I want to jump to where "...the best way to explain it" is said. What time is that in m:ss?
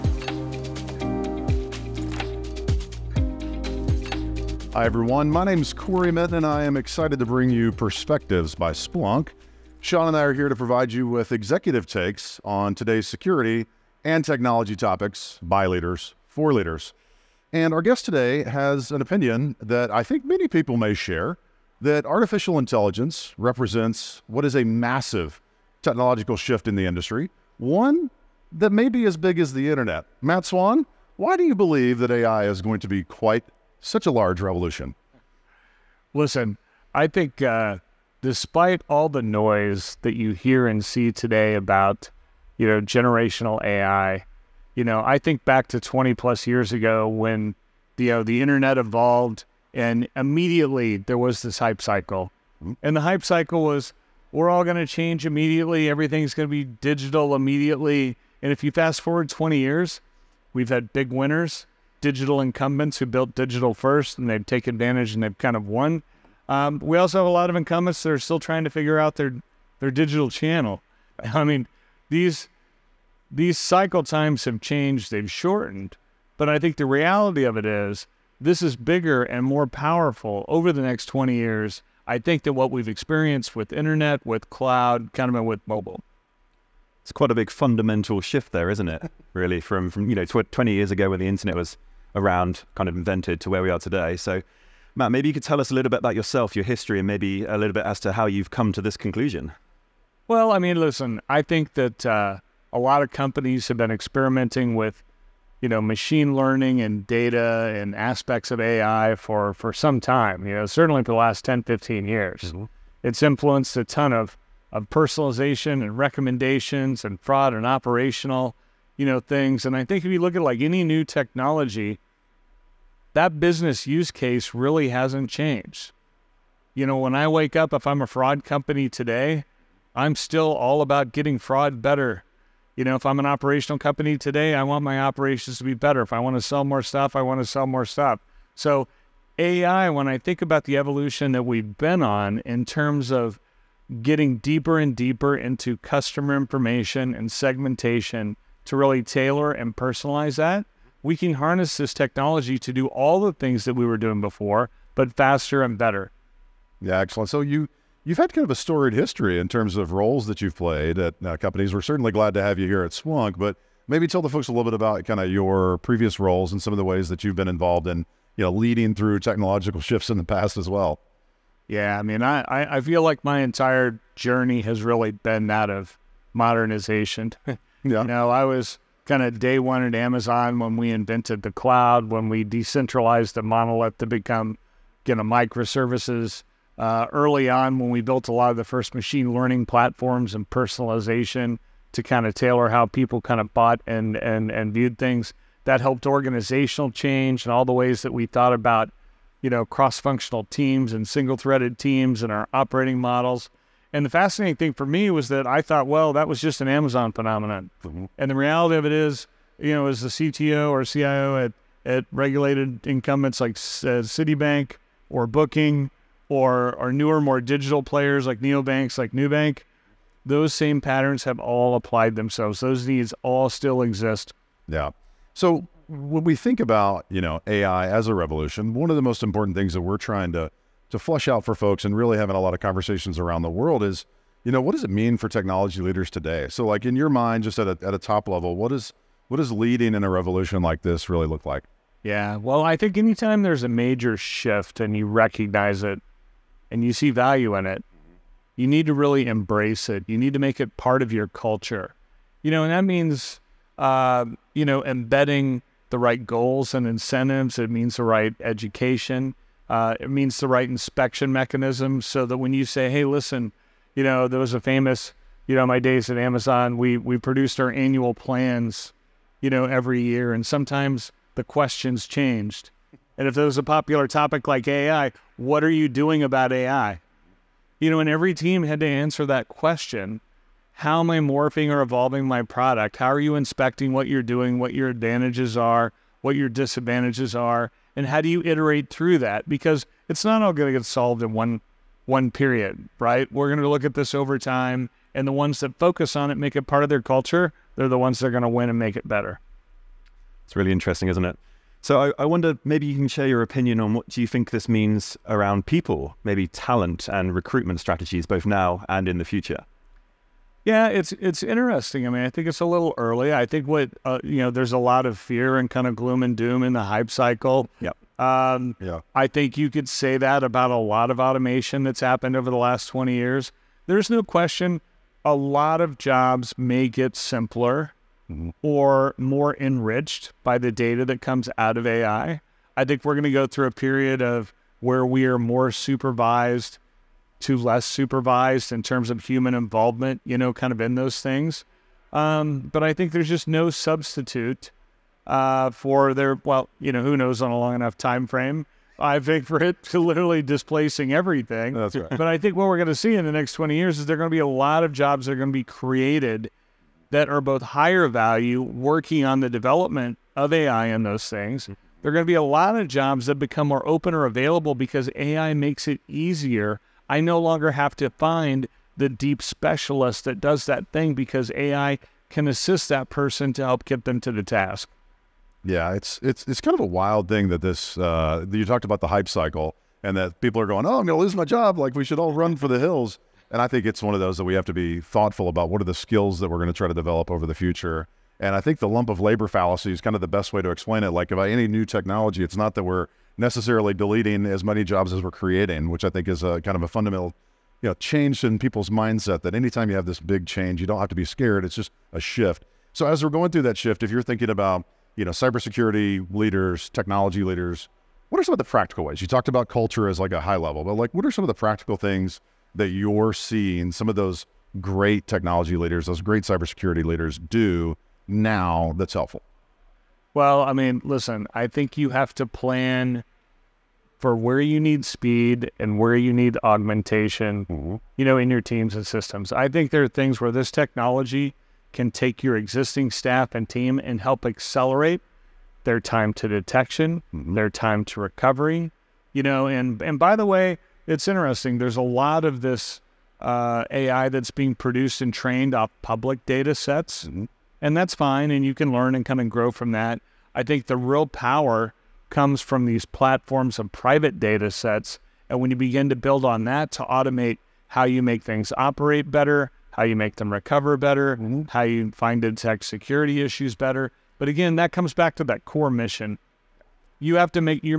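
6:30.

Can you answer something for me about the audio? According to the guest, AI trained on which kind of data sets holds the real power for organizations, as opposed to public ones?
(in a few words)
private data sets.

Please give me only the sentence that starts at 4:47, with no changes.
and how do you iterate through that?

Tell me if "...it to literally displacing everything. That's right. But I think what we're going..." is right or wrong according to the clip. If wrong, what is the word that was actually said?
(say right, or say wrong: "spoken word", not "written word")
right.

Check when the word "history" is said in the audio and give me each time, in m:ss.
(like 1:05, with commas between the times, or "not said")
1:36, 2:38.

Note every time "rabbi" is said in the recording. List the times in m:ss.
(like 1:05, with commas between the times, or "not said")
not said.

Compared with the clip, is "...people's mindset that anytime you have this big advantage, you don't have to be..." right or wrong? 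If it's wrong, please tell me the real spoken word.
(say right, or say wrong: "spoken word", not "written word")
wrong: "change", not "advantage".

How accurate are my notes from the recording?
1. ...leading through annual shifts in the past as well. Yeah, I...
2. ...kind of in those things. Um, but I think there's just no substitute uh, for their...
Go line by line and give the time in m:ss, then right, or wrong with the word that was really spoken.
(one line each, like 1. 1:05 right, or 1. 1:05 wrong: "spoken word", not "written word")
1. 2:48 wrong: "technological", not "annual"
2. 5:40 right.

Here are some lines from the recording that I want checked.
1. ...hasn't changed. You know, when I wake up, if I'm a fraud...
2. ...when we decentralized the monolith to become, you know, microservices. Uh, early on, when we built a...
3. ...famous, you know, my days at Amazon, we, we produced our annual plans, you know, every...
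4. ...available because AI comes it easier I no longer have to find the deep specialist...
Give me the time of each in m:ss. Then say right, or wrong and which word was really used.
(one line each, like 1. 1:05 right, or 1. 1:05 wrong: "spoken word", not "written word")
1. 2:04 right
2. 3:02 right
3. 4:24 right
4. 6:04 wrong: "makes", not "comes".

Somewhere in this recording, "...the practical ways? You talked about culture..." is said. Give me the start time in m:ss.
6:48.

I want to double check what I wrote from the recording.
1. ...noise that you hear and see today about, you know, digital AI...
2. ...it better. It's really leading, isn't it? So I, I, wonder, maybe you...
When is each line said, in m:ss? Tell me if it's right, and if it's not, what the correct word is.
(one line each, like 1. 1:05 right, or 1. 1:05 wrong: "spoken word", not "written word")
1. 0:39 wrong: "generational", not "digital"
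2. 4:58 wrong: "interesting", not "leading".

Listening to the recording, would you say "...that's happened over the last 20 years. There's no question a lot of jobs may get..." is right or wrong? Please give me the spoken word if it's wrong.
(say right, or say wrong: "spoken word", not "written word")
right.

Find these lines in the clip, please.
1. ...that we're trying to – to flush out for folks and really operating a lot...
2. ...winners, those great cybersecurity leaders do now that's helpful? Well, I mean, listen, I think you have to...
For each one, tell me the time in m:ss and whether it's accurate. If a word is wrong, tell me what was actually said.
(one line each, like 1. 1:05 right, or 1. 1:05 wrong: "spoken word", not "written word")
1. 3:49 wrong: "having", not "operating"
2. 6:55 wrong: "leaders", not "winners".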